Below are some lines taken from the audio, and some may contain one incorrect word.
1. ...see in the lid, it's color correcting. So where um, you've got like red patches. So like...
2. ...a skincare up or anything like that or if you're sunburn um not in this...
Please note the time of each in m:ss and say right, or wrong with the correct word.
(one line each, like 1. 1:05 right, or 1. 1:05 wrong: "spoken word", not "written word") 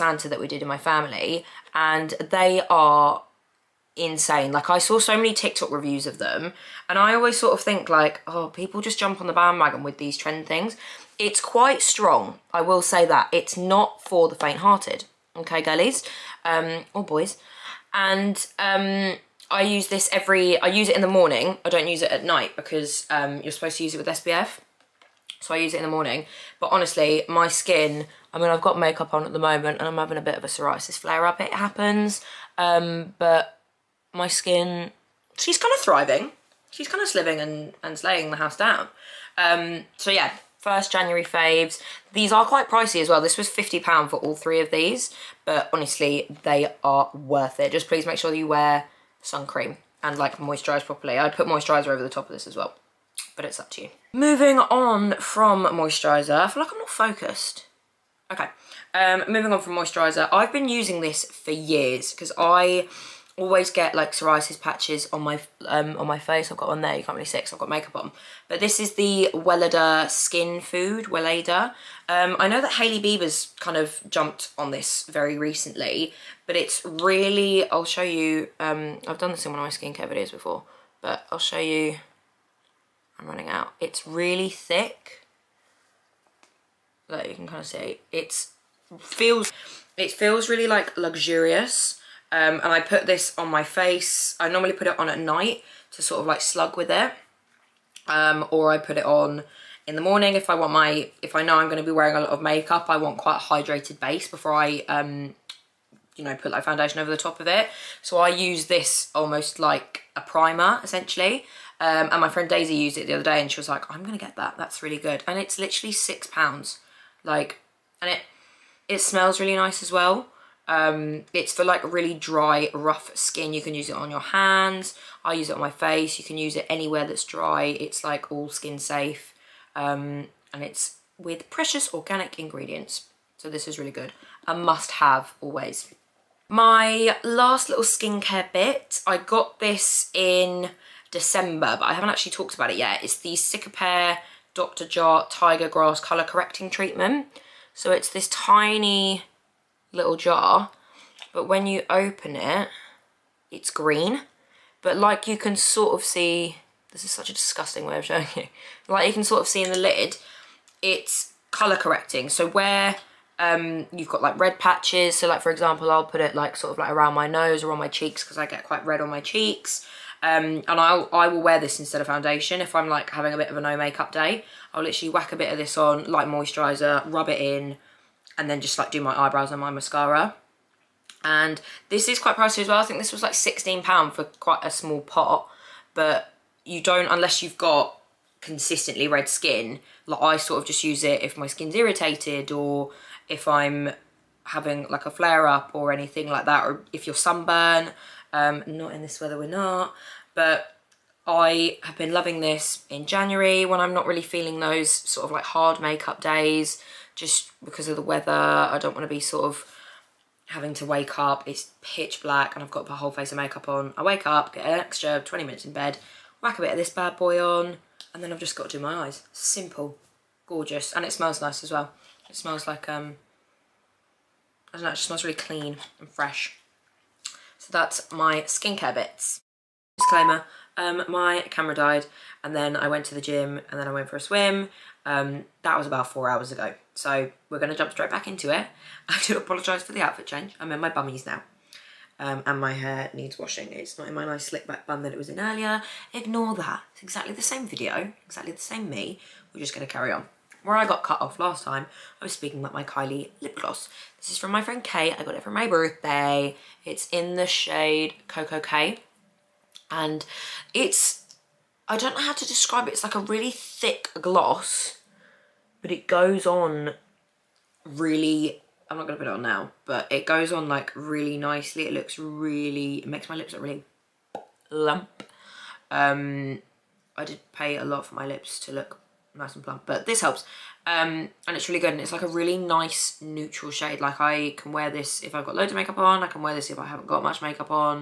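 1. 2:39 right
2. 3:15 wrong: "flare", not "skincare".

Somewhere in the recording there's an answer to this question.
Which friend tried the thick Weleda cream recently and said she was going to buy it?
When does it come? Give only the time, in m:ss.
1:52.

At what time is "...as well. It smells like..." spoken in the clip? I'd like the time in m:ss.
3:41.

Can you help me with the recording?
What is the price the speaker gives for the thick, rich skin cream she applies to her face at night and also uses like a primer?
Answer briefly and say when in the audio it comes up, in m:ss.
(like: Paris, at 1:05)
6 pounds, at 1:55.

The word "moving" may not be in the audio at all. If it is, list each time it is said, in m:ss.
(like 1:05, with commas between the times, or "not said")
0:54, 0:59.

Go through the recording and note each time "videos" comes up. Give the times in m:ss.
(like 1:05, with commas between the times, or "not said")
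1:20, 4:07.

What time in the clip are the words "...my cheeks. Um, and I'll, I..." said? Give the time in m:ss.
2:49.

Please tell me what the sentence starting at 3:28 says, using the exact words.
I don't want to be sort of having to wake up.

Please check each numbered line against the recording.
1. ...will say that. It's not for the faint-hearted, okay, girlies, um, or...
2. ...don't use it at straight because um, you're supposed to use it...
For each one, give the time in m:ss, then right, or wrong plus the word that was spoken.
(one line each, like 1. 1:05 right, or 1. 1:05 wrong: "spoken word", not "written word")
1. 0:12 right
2. 0:21 wrong: "night", not "straight".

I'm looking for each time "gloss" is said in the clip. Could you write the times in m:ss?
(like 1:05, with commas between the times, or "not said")
4:13, 4:24.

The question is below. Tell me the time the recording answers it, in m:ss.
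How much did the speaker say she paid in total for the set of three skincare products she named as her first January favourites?
0:43.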